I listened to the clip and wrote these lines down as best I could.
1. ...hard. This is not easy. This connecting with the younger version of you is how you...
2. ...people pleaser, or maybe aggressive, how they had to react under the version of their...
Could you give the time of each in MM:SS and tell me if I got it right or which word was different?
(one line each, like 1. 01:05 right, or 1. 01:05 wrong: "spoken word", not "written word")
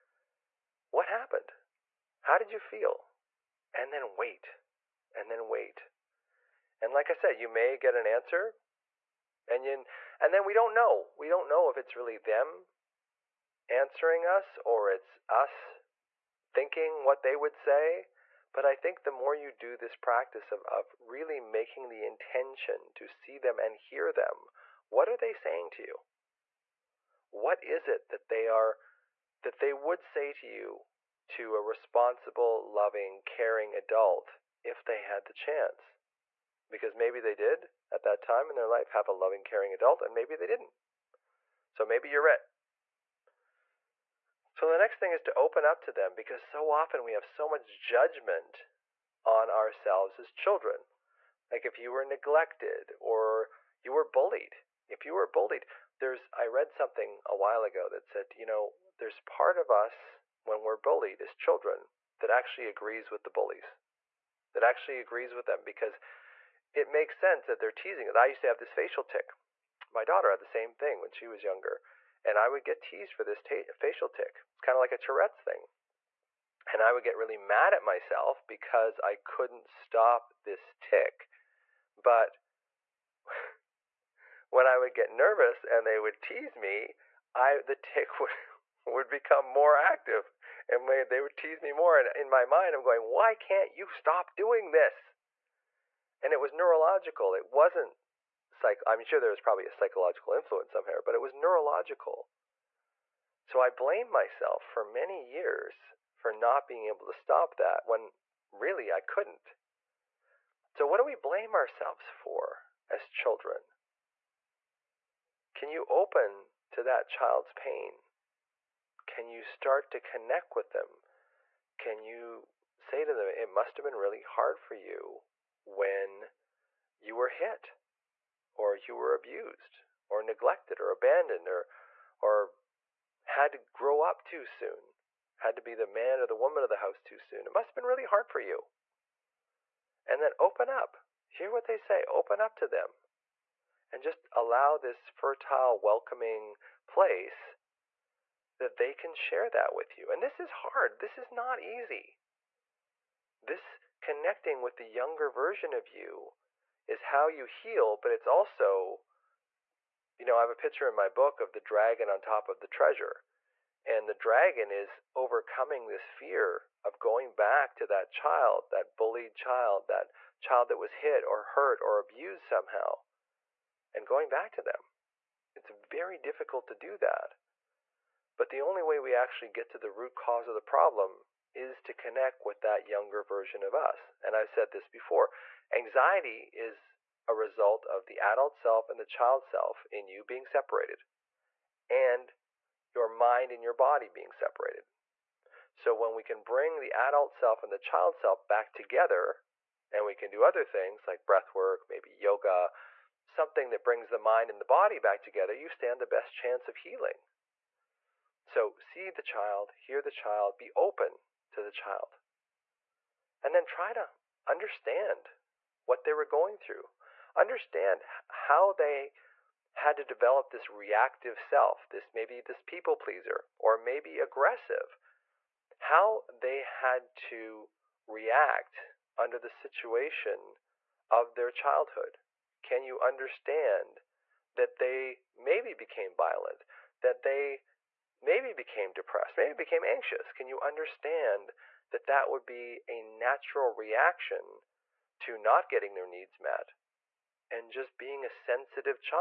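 1. 02:30 right
2. 03:42 wrong: "situation", not "version".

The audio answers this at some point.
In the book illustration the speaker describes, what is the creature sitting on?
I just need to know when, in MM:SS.
02:42.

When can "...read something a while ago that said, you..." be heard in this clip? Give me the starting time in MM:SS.
00:56.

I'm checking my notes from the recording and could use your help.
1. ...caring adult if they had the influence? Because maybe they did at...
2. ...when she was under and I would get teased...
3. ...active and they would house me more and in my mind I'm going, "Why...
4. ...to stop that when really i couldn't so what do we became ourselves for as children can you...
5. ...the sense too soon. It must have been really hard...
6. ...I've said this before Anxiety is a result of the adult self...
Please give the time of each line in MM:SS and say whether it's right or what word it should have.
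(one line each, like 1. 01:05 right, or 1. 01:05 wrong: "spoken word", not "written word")
1. 00:33 wrong: "chance", not "influence"
2. 01:11 wrong: "younger", not "under"
3. 01:29 wrong: "tease", not "house"
4. 01:47 wrong: "blame", not "became"
5. 02:16 wrong: "house", not "sense"
6. 03:04 right.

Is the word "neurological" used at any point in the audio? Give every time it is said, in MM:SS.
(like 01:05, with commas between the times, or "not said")
01:36, 01:41.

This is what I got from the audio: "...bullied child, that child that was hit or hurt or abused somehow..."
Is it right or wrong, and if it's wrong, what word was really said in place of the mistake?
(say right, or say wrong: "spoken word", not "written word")
right.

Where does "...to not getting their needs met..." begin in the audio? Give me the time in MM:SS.
04:05.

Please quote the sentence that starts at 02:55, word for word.
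It's very difficult to do that.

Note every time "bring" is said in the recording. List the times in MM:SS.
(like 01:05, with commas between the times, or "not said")
03:16, 03:23.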